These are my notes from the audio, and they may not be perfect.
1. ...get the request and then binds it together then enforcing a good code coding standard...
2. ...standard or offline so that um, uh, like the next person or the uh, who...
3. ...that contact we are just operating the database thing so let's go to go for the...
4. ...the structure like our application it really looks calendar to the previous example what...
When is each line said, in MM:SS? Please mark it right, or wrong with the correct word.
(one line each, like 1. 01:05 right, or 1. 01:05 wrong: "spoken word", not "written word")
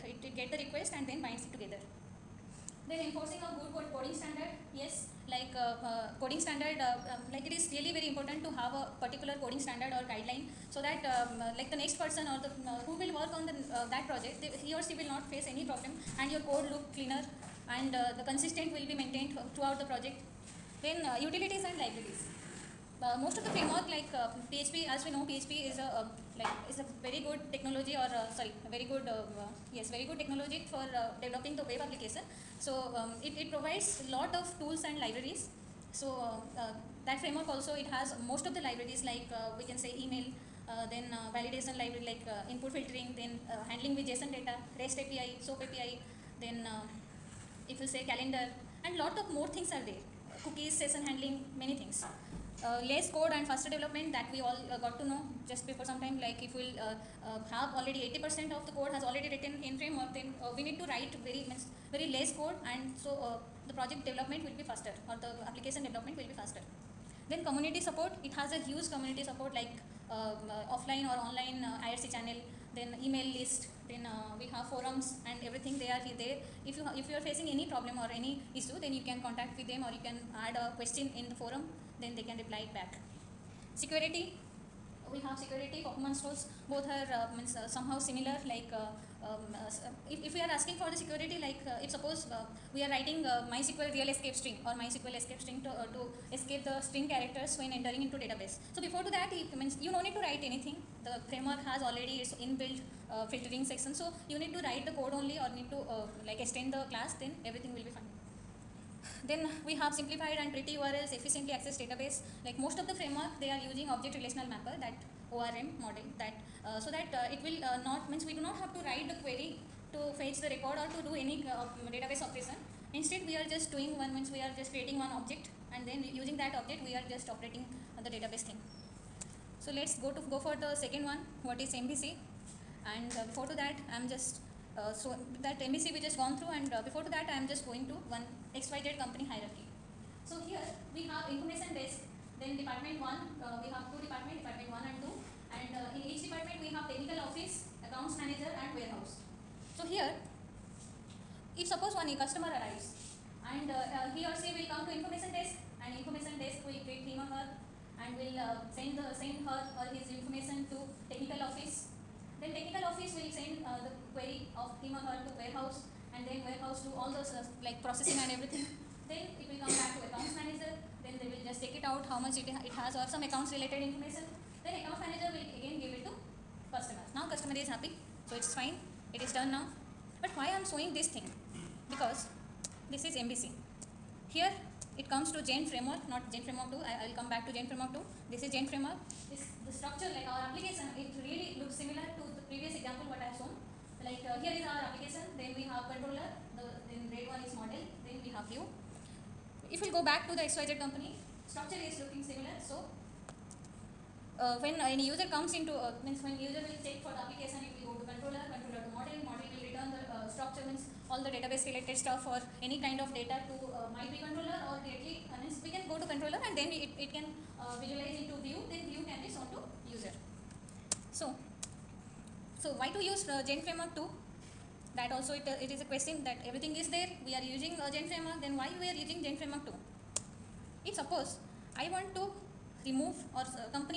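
1. 00:00 right
2. 00:09 wrong: "guideline", not "offline"
3. 02:06 wrong: "object", not "contact"
4. 03:09 wrong: "similar", not "calendar".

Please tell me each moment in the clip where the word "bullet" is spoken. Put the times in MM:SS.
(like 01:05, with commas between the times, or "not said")
not said.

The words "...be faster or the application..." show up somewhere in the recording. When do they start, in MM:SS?
01:04.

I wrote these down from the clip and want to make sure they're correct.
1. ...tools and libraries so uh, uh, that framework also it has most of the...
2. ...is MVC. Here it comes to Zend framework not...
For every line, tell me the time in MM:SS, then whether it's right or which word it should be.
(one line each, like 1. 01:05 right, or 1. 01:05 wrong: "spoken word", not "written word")
1. 00:34 right
2. 03:03 right.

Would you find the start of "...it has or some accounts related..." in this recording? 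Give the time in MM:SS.
02:52.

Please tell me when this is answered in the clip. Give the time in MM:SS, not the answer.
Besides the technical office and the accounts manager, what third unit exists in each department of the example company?
02:28.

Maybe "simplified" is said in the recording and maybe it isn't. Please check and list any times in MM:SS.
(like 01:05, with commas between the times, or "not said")
01:49.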